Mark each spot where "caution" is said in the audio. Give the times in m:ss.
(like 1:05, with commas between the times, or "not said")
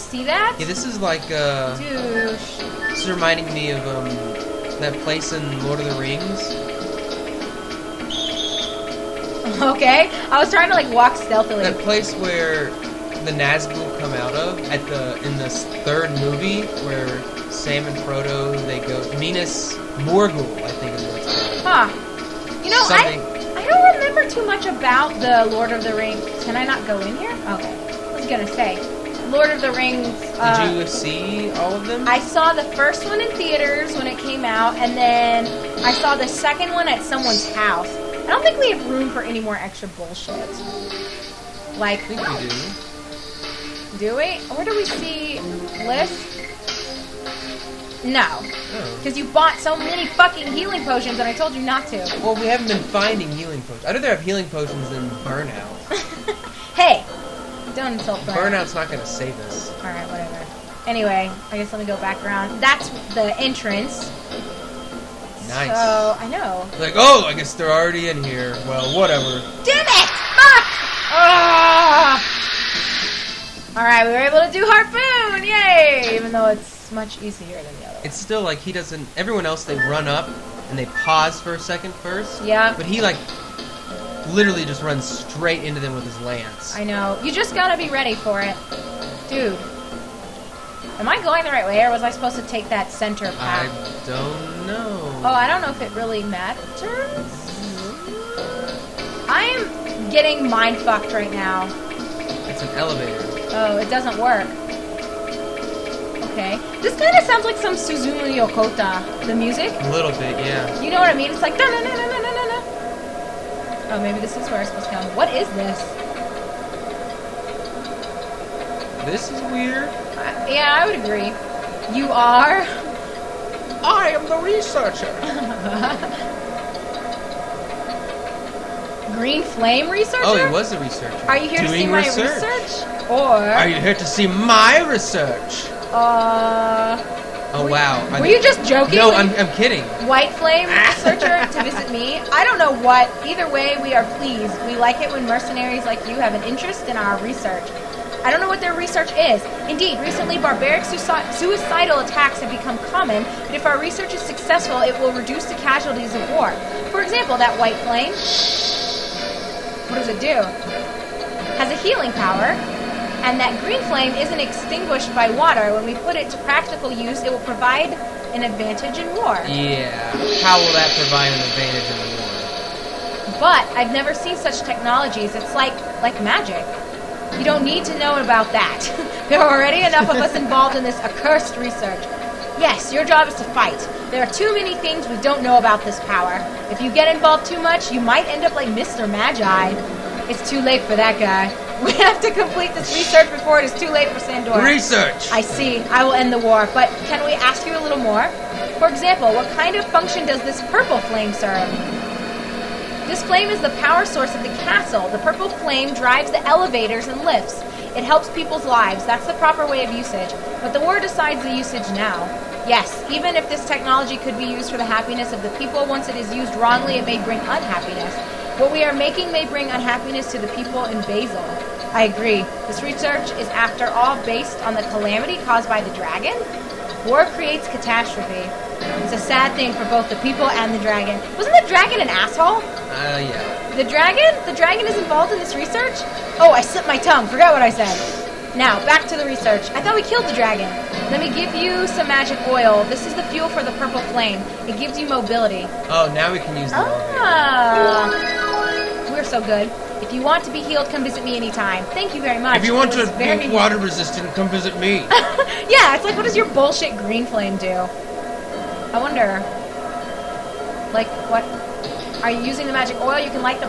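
not said.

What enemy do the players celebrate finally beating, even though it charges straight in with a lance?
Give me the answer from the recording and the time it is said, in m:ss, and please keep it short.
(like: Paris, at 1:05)
Harpoon, at 1:14.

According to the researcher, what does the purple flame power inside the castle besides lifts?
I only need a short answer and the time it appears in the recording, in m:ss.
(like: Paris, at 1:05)
Elevators, at 3:26.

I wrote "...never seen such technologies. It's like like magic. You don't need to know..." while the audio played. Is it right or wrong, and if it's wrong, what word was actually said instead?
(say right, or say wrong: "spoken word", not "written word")
right.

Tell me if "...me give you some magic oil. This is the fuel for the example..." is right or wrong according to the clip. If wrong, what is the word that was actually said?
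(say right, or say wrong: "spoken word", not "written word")
wrong: "purple", not "example".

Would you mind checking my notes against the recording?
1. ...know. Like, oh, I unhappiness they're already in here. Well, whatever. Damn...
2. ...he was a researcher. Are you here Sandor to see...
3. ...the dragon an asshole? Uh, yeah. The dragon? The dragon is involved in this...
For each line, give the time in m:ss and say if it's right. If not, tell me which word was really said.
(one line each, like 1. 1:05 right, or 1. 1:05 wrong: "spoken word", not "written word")
1. 1:06 wrong: "guess", not "unhappiness"
2. 2:10 wrong: "Doing", not "Sandor"
3. 3:51 right.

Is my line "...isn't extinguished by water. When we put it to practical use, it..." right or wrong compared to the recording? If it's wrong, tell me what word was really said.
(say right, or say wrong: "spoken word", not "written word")
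right.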